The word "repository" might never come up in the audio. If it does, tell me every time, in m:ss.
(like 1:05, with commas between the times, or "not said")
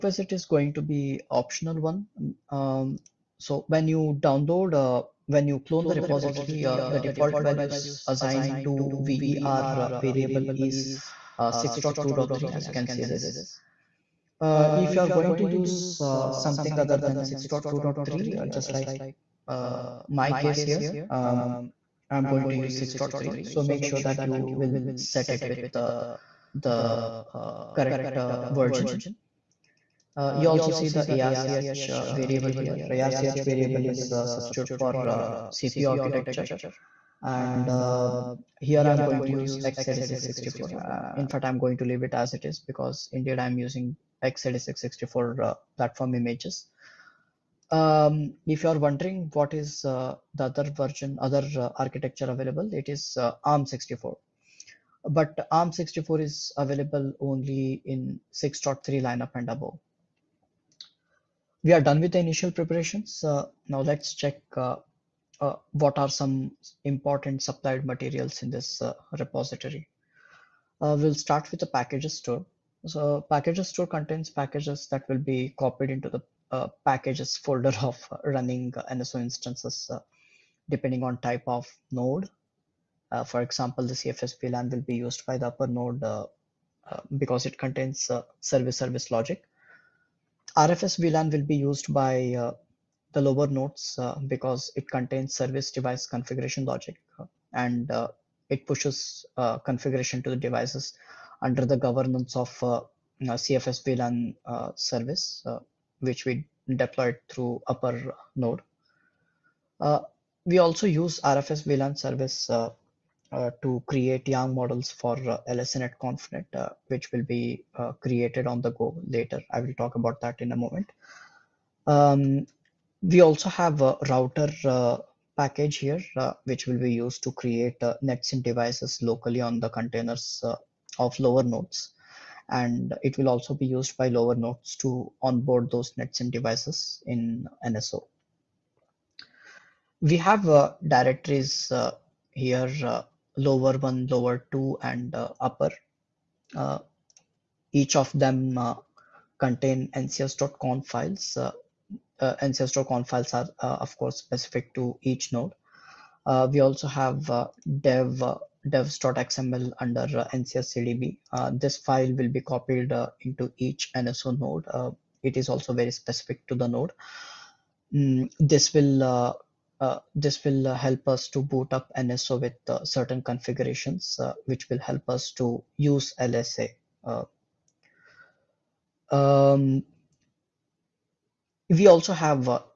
0:05, 1:09.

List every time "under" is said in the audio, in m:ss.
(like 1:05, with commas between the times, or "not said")
1:41, 2:39.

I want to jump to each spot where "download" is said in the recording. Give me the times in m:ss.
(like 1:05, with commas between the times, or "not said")
0:04.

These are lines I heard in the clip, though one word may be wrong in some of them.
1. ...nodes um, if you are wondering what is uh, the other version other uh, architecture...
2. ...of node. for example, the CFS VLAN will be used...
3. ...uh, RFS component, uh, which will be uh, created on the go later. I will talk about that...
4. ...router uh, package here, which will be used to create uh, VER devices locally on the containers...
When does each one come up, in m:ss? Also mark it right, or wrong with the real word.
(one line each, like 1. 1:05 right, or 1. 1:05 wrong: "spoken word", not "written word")
1. 0:46 wrong: "images", not "nodes"
2. 1:21 right
3. 1:55 wrong: "LSNet", not "RFS"
4. 2:04 wrong: "NetSIM", not "VER".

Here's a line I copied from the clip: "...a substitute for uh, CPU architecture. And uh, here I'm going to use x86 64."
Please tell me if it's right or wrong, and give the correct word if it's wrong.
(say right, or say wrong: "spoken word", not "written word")
right.